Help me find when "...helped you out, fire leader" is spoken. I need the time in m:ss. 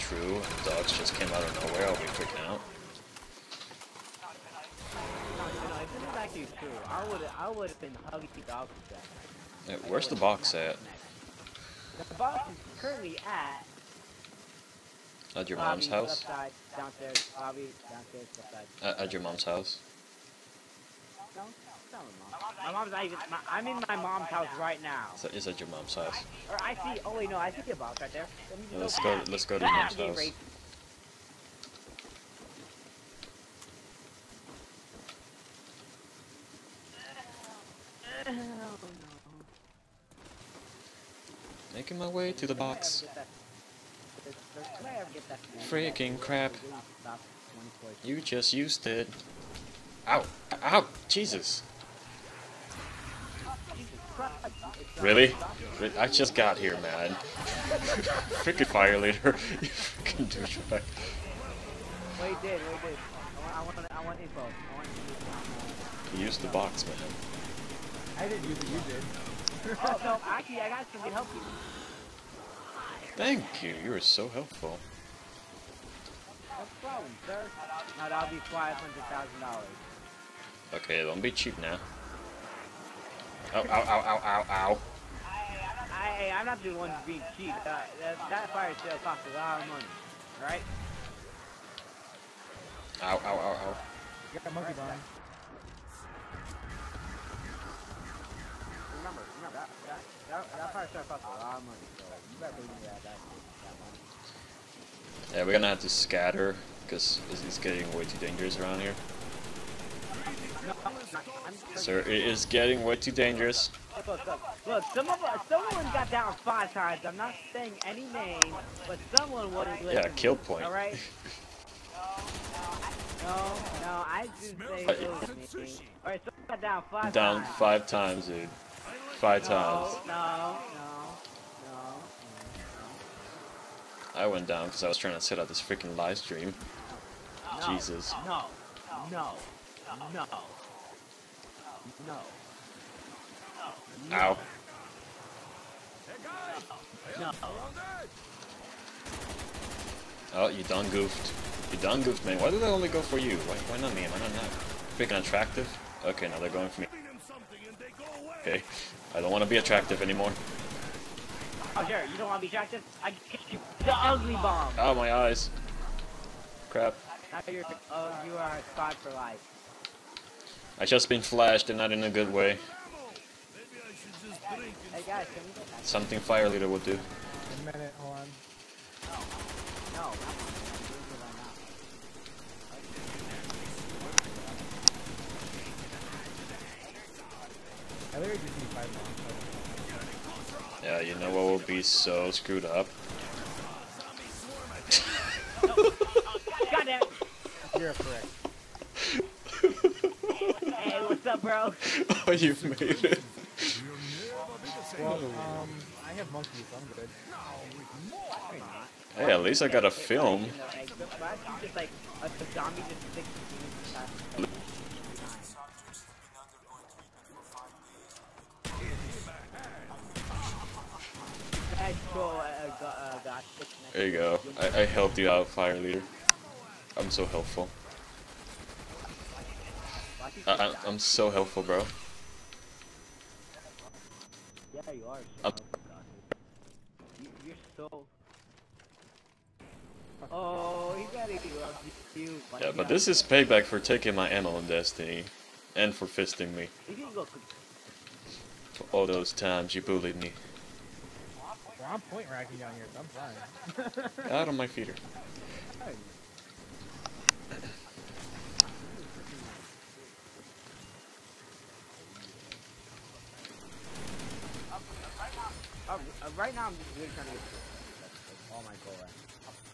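3:44.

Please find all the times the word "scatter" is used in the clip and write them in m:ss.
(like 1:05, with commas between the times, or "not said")
1:45.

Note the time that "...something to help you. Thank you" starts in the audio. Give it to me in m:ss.
1:10.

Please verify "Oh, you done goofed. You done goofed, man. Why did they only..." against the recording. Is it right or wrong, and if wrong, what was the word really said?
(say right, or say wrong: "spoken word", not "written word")
right.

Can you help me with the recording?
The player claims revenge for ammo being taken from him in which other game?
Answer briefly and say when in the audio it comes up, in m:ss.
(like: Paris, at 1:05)
Destiny, at 4:04.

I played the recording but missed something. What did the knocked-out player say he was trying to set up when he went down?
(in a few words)
live stream.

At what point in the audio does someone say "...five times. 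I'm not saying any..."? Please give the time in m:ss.
1:56.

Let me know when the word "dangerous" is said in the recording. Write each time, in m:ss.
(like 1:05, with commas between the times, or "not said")
1:48, 1:53.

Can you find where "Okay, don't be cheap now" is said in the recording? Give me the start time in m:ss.
1:20.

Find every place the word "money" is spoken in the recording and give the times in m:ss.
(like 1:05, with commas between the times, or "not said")
1:29, 1:41.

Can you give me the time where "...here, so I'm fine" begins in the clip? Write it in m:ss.
4:12.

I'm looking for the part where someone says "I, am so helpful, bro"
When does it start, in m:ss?
3:50.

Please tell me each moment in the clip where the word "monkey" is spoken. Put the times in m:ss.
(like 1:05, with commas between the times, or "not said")
1:34, 3:26.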